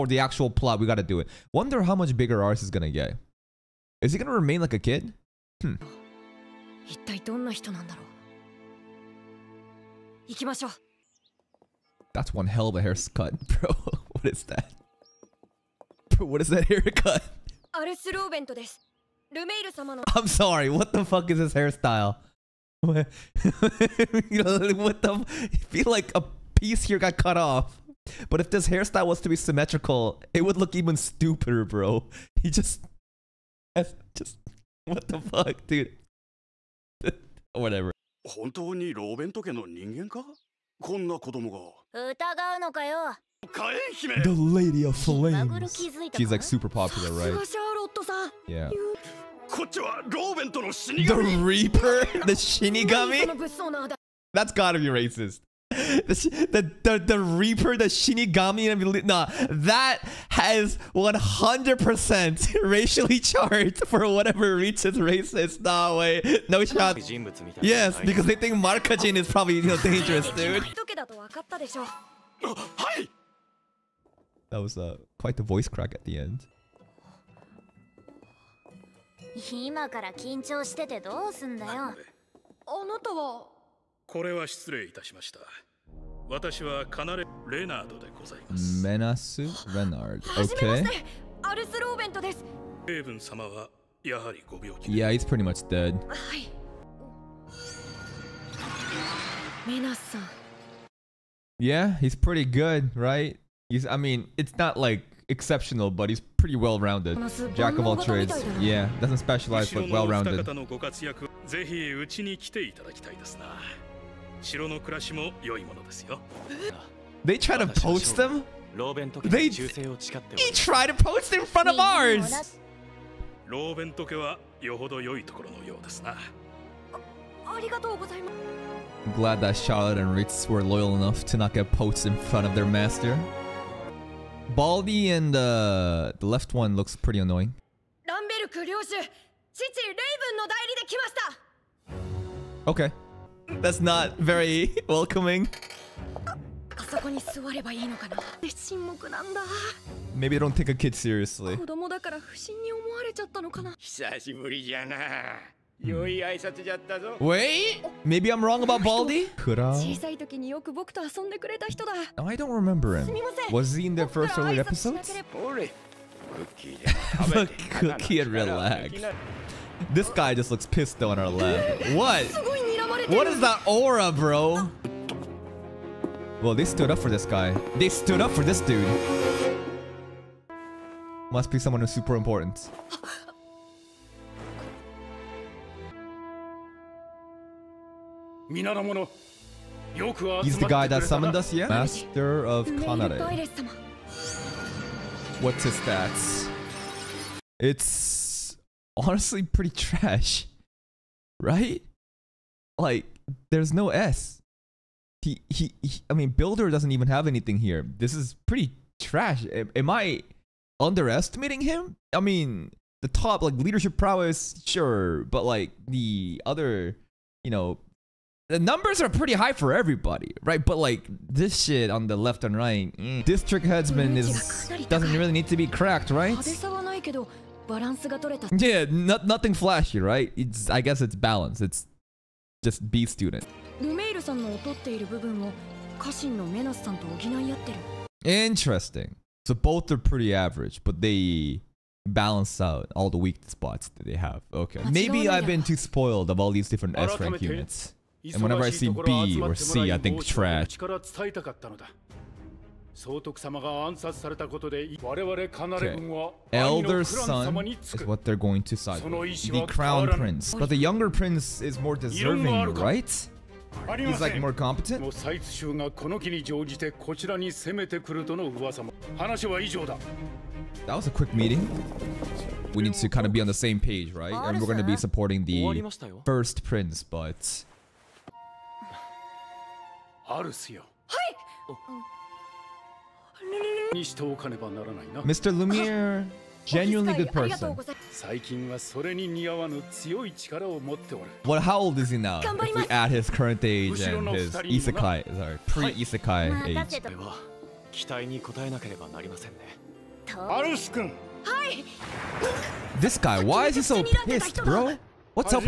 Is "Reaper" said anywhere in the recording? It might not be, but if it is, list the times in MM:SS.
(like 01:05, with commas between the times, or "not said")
00:51, 00:57.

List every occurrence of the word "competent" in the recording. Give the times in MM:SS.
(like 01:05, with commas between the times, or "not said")
04:24.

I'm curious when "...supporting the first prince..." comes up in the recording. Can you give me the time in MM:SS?
04:34.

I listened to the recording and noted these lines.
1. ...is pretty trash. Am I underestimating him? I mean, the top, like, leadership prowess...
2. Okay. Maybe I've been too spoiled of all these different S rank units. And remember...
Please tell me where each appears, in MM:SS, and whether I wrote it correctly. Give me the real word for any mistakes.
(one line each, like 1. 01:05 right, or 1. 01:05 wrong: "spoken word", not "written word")
1. 03:28 right
2. 04:04 wrong: "whenever", not "remember".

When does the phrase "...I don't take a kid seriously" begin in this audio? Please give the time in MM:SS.
02:30.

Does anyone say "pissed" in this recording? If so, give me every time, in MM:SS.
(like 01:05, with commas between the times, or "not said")
02:50, 05:04.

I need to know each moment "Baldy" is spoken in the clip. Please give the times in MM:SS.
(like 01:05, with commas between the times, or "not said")
02:14, 02:38.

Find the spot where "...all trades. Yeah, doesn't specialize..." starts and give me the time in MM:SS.
01:47.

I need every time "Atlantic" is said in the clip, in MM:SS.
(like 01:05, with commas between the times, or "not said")
not said.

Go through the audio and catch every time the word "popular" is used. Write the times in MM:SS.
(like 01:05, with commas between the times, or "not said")
00:46.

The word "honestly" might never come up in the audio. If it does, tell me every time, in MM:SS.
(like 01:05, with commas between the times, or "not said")
03:18.